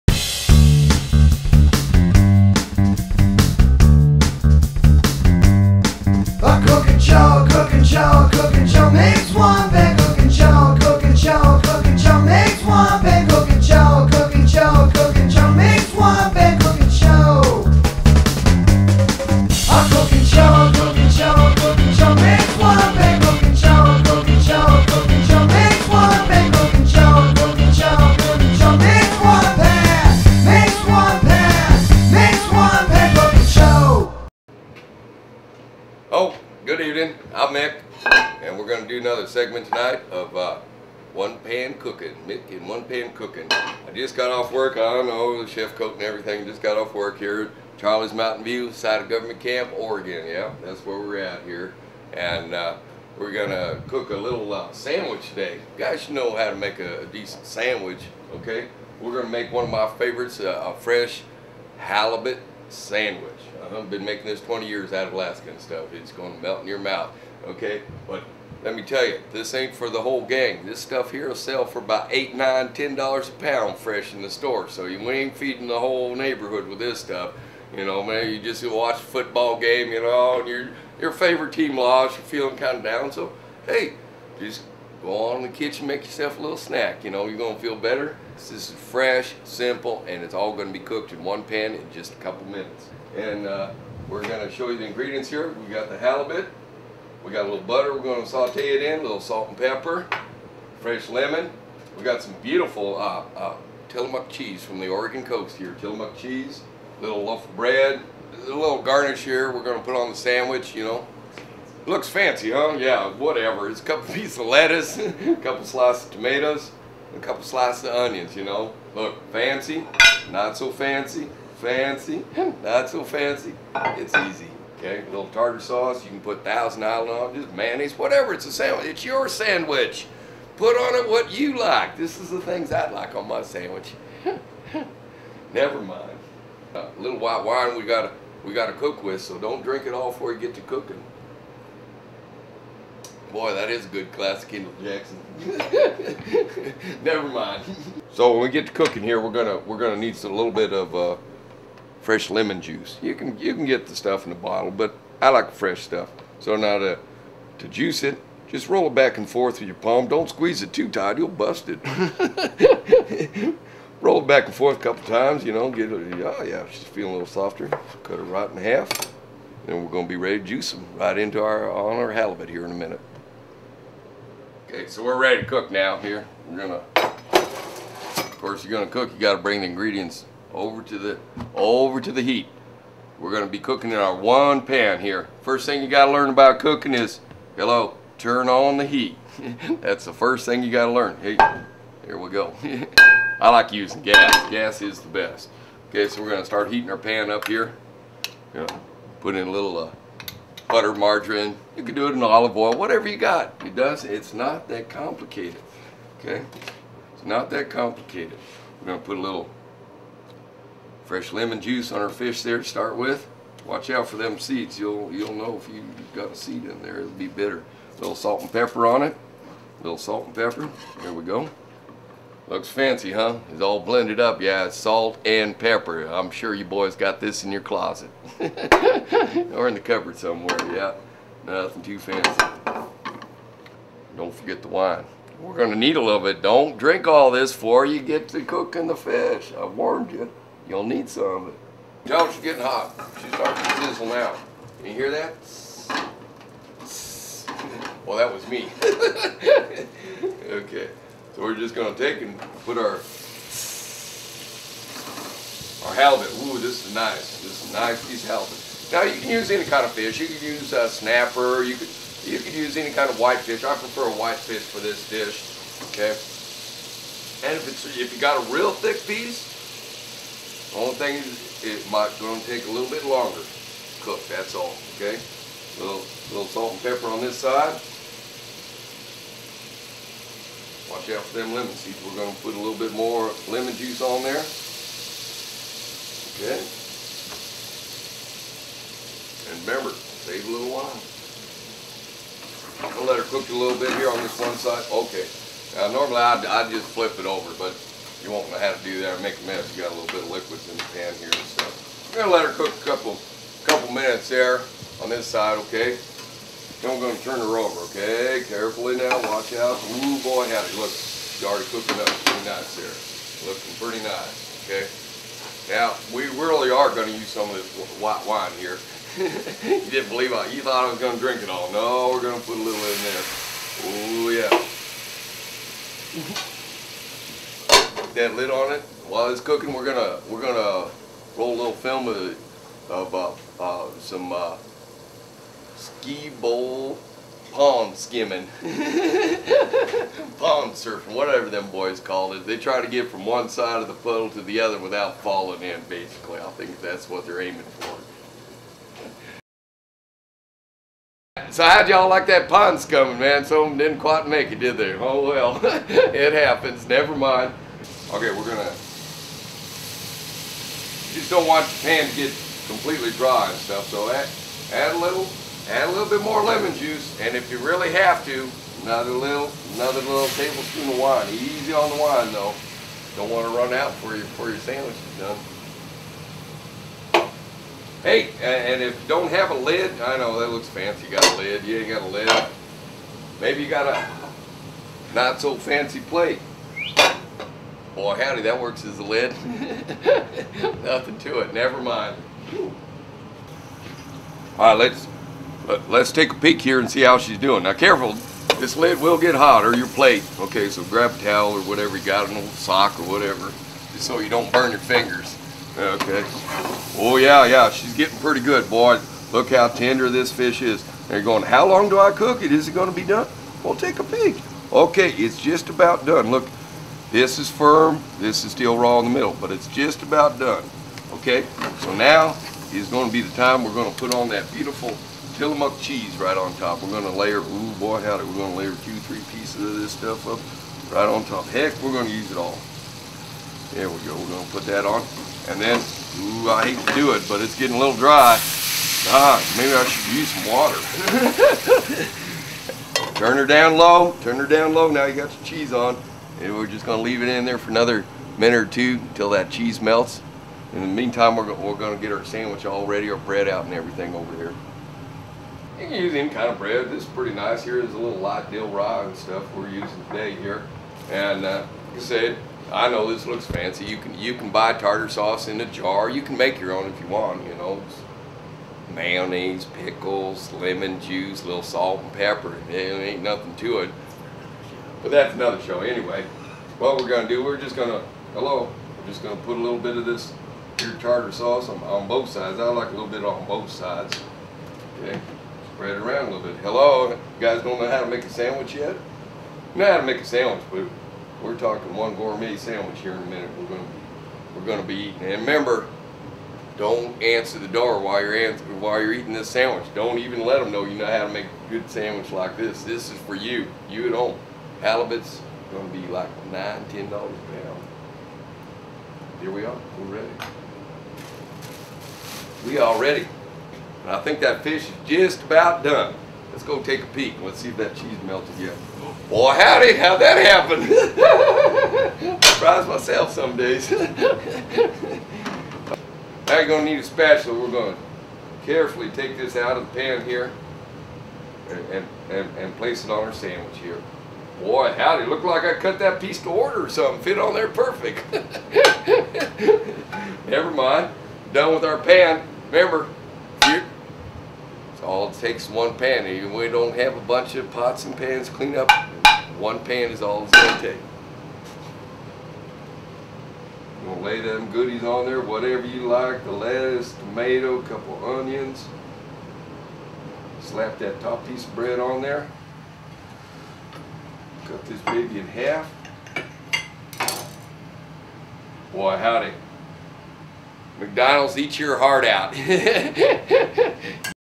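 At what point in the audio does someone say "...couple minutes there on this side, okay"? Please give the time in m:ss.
5:03.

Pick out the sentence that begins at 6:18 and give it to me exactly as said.
Hey, and if you don't have a lid, I know that looks fancy.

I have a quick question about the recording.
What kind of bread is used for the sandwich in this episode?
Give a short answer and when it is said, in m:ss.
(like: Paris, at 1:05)
Light dill rye, at 7:38.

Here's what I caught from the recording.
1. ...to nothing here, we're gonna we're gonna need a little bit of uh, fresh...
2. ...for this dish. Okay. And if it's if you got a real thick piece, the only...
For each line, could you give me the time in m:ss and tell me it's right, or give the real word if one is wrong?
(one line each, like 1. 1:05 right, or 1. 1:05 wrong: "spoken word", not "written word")
1. 2:28 wrong: "cooking", not "nothing"
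2. 4:24 right.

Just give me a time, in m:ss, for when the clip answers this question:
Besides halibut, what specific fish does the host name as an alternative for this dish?
4:20.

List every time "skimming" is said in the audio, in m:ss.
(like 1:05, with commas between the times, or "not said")
5:37.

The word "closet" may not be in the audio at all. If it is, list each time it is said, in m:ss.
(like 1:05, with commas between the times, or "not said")
3:47.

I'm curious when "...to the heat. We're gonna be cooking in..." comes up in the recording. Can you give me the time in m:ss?
3:01.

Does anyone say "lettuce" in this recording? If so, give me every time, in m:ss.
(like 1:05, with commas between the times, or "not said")
1:54, 9:16.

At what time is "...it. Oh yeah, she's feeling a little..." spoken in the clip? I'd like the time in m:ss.
2:45.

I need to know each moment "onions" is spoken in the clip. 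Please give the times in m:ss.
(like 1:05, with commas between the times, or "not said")
1:57, 9:18.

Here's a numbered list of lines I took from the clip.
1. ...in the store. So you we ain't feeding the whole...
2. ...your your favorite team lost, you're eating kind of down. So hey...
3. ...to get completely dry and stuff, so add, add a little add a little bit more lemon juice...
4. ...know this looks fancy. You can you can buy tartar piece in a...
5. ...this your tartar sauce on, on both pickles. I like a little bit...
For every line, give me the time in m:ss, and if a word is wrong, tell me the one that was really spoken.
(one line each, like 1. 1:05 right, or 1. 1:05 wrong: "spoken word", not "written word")
1. 1:14 right
2. 1:20 wrong: "feeling", not "eating"
3. 6:02 right
4. 7:42 wrong: "sauce", not "piece"
5. 8:00 wrong: "sides", not "pickles".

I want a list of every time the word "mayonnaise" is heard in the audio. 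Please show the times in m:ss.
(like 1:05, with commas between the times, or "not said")
2:07, 7:48.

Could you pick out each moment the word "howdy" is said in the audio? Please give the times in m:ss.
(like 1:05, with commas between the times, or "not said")
5:10, 6:28, 7:08, 8:39, 8:54, 9:29.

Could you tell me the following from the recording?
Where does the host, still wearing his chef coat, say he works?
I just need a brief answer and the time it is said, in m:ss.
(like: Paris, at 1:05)
Charlie's Mountain View, at 0:47.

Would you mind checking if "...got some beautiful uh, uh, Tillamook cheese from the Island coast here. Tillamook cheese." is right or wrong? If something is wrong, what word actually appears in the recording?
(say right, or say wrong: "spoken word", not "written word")
wrong: "Oregon", not "Island".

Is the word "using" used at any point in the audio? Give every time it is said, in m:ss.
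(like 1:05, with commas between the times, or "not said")
3:13, 7:39.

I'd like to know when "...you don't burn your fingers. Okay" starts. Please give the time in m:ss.
6:44.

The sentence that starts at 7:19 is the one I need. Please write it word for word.
Ah, maybe I should use some water.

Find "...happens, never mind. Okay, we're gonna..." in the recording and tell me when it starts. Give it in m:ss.
5:56.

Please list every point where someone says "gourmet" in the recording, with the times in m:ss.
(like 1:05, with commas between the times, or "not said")
8:12.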